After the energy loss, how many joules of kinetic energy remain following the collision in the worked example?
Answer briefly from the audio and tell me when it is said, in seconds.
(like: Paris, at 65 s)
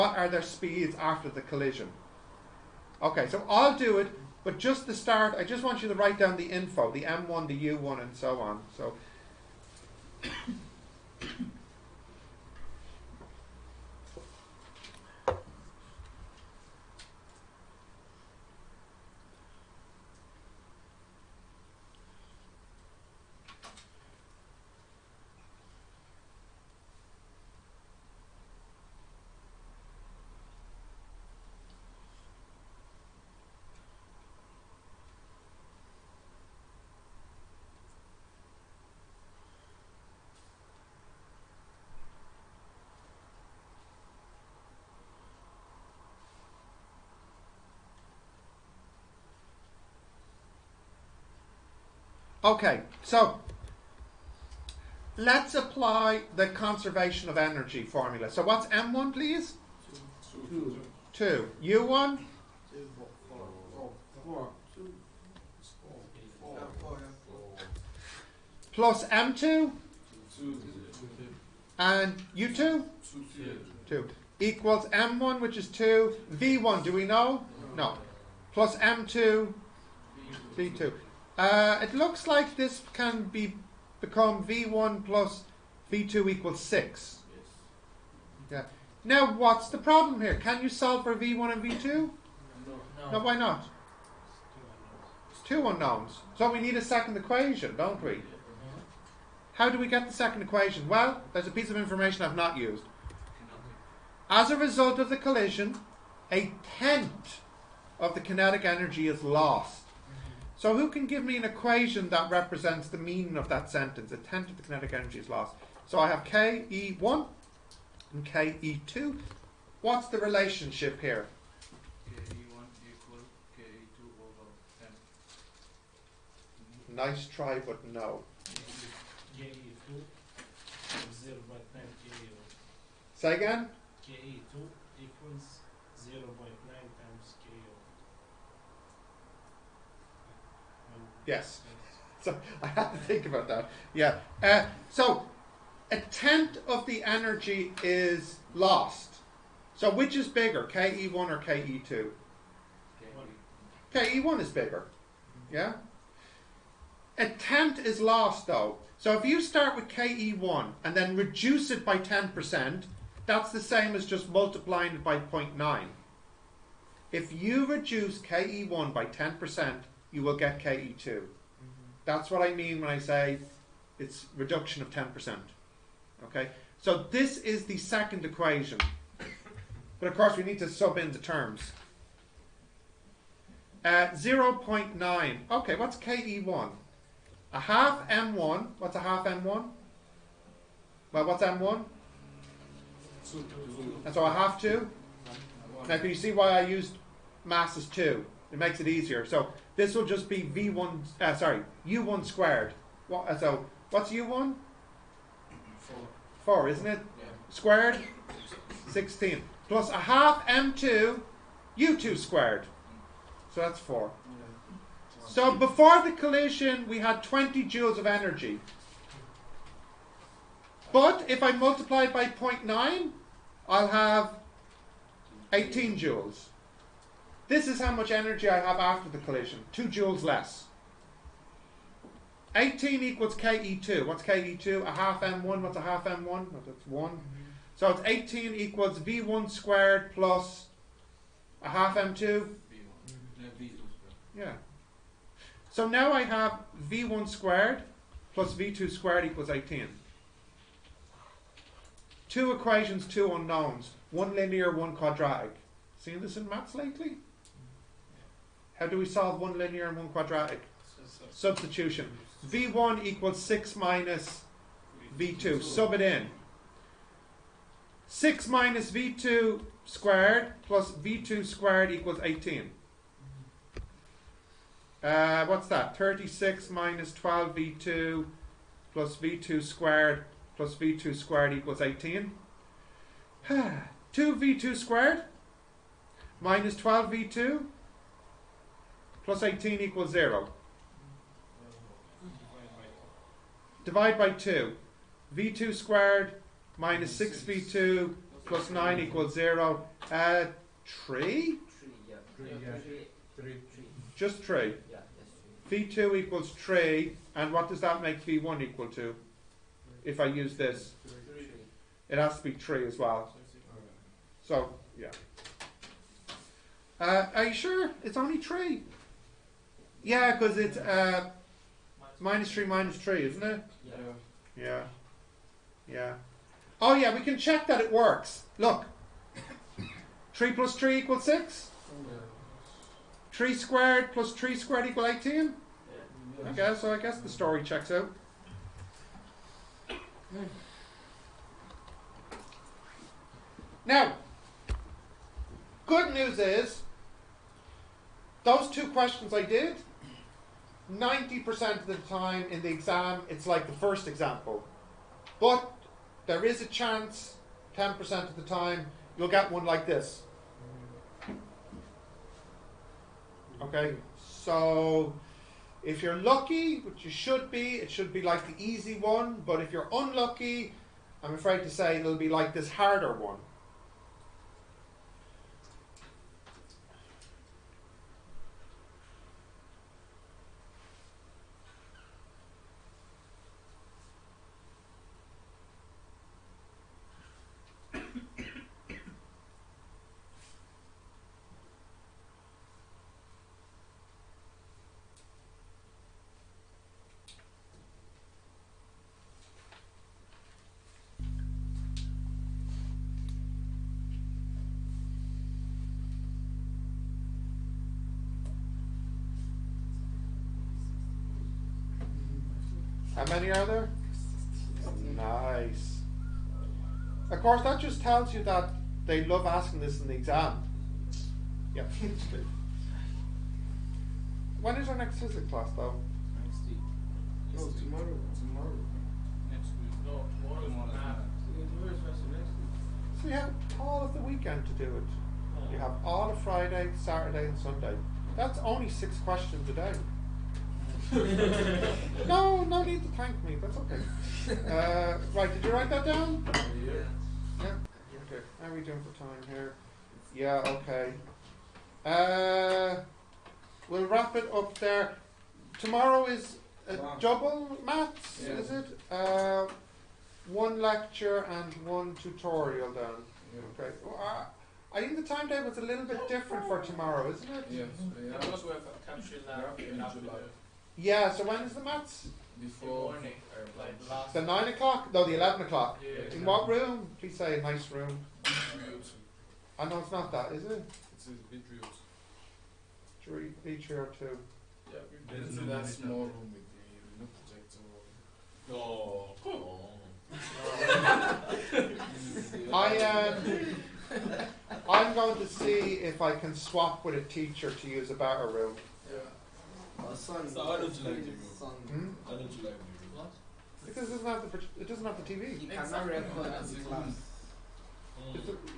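18 joules, at 225 s.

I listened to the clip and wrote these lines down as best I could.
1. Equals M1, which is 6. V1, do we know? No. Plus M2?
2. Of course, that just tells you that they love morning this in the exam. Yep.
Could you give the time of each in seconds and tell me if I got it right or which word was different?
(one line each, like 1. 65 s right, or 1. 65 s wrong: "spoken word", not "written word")
1. 74 s wrong: "2", not "6"
2. 417 s wrong: "asking", not "morning".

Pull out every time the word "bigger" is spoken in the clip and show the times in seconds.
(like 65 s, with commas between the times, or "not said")
150 s, 154 s.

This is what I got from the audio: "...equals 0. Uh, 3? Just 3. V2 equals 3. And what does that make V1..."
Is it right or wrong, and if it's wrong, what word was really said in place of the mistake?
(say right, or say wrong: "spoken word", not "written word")
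right.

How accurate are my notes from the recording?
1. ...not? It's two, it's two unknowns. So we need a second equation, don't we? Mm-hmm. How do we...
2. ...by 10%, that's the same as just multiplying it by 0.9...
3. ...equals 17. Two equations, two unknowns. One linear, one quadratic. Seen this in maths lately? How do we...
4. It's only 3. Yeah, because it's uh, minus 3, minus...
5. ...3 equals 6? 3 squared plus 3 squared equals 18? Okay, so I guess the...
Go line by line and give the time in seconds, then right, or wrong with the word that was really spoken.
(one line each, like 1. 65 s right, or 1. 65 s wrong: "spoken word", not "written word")
1. 93 s right
2. 161 s right
3. 249 s wrong: "18", not "17"
4. 318 s right
5. 330 s right.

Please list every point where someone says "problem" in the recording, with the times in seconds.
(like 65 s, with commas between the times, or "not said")
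89 s.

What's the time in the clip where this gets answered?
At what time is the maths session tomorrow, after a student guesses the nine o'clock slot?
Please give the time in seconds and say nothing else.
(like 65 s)
475 s.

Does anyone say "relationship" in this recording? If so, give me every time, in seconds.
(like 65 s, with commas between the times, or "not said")
120 s.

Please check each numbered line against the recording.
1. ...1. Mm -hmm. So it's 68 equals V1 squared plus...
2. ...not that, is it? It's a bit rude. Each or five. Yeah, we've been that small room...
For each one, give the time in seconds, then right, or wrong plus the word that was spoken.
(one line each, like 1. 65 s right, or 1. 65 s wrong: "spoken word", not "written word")
1. 236 s wrong: "18", not "68"
2. 480 s wrong: "two", not "five".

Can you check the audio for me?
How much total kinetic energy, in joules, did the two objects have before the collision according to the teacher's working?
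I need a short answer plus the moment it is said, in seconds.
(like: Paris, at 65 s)
20 joules, at 217 s.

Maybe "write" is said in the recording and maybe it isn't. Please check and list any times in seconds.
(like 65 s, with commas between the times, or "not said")
5 s, 445 s.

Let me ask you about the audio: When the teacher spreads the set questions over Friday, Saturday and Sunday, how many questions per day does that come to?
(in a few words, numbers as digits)
6.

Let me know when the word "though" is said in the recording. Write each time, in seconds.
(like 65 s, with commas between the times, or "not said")
158 s, 425 s.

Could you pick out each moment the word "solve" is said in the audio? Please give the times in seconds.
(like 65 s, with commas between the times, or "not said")
90 s, 259 s.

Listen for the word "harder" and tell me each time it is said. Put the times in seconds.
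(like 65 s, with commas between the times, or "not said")
372 s.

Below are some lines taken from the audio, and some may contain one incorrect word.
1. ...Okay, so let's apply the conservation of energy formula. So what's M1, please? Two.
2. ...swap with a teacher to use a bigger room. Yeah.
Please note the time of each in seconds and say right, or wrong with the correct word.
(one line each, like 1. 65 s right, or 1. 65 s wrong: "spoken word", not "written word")
1. 52 s right
2. 496 s wrong: "better", not "bigger".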